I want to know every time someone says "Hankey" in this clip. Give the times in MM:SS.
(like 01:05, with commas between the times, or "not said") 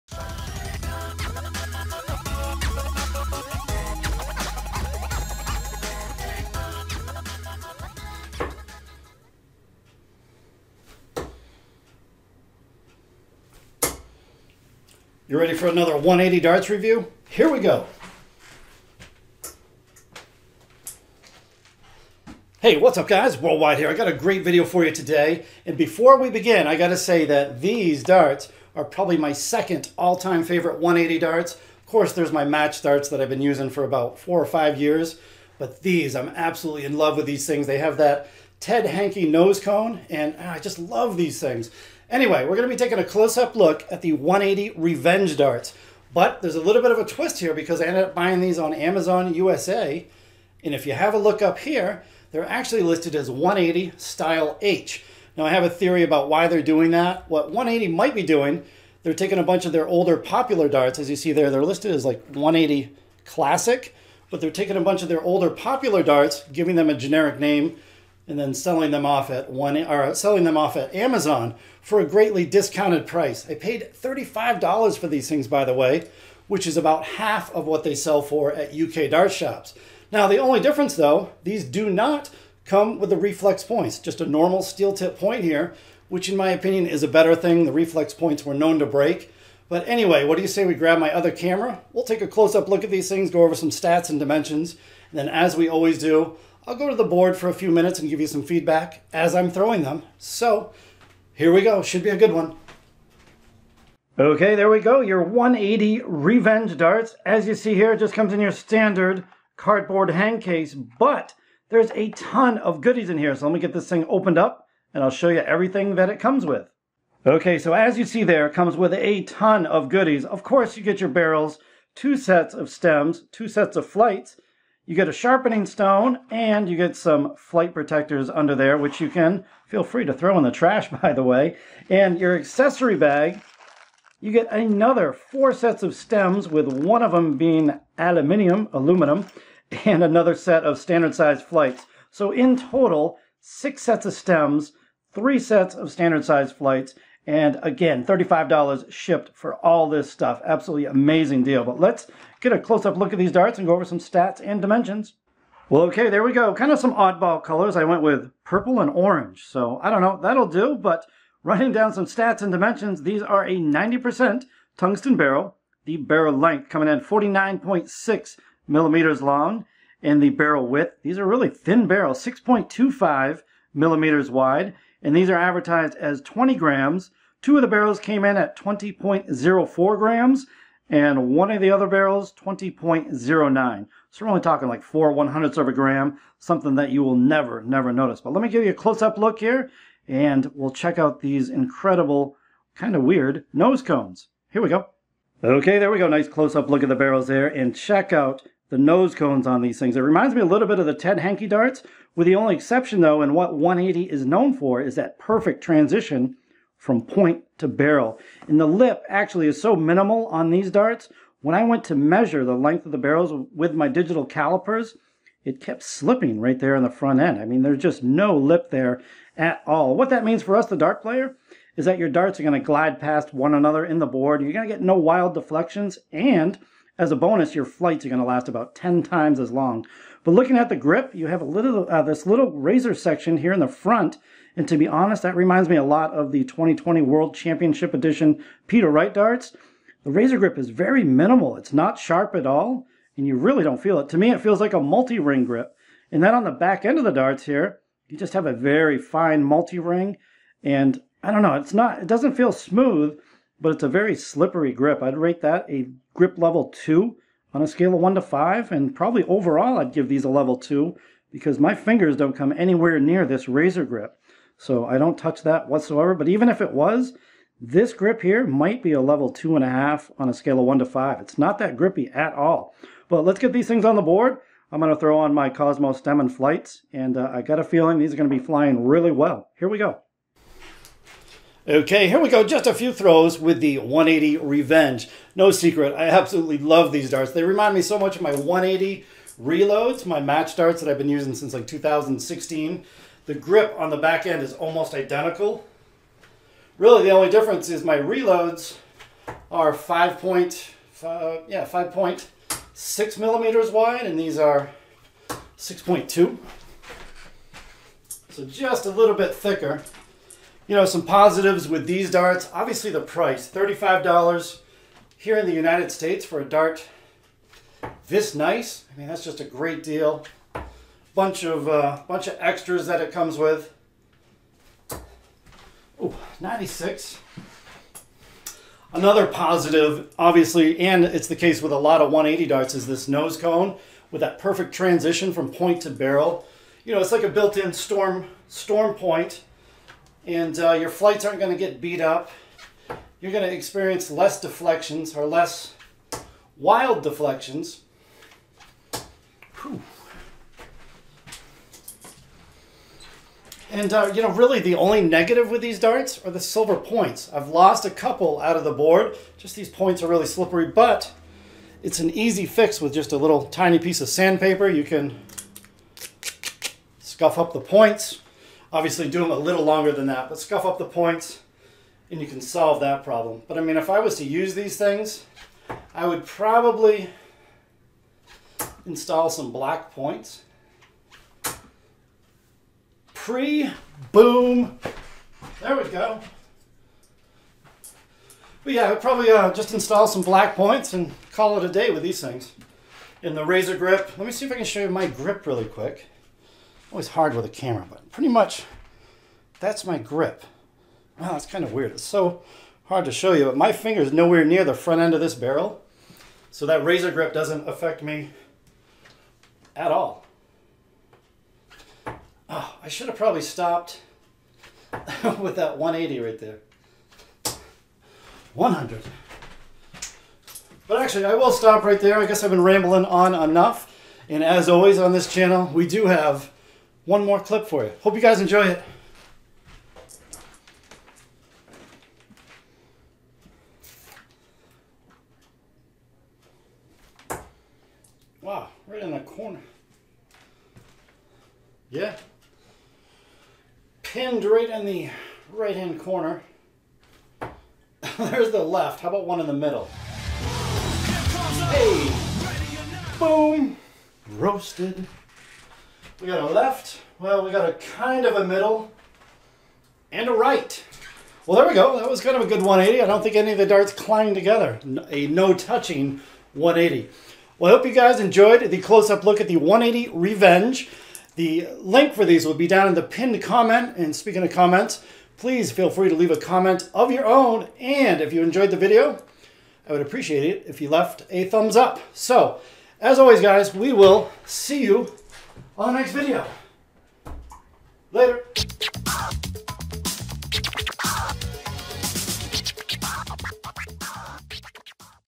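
00:38, 03:21.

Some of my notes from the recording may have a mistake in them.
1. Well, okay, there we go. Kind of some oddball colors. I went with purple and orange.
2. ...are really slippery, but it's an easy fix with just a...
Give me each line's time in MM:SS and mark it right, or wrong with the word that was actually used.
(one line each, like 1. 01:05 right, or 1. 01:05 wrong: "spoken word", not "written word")
1. 02:35 right
2. 06:00 right.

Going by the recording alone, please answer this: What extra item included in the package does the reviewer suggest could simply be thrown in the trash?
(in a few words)
flight protectors.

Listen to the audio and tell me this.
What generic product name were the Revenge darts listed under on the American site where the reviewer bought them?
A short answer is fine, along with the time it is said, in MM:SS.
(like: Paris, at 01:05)
One80 Style H, at 00:53.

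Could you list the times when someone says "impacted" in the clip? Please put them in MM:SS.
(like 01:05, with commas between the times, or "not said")
not said.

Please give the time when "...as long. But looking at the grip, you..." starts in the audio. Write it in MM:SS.
03:49.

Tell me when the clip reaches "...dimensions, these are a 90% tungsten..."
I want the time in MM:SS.
02:42.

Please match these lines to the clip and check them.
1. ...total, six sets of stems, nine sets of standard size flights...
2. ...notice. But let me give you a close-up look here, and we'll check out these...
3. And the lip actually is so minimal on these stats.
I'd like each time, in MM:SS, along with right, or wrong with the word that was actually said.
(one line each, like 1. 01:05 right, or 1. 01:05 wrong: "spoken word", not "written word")
1. 02:22 wrong: "three", not "nine"
2. 03:07 right
3. 03:28 wrong: "darts", not "stats".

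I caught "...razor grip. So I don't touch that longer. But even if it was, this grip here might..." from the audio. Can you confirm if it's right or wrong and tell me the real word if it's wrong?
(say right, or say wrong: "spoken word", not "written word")
wrong: "whatsoever", not "longer".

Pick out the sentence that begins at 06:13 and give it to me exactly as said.
But I mean, if I was to use these things, I would probably install some black points.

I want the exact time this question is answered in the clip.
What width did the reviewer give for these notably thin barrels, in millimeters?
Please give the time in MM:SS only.
02:52.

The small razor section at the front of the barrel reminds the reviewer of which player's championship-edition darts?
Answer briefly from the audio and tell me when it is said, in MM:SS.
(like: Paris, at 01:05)
Peter Wright, at 03:58.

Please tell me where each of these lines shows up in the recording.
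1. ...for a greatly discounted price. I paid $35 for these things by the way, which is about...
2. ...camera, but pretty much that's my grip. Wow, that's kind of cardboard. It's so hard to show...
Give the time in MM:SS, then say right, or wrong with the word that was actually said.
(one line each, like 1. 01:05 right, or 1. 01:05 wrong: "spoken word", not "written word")
1. 01:11 right
2. 06:37 wrong: "weird", not "cardboard".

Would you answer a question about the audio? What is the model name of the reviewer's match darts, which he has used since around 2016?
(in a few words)
One80 Reloads.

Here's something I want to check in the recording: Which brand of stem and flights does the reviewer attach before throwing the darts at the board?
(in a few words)
Cosmo.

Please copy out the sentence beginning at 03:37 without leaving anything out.
I mean, there's just no lip there at all.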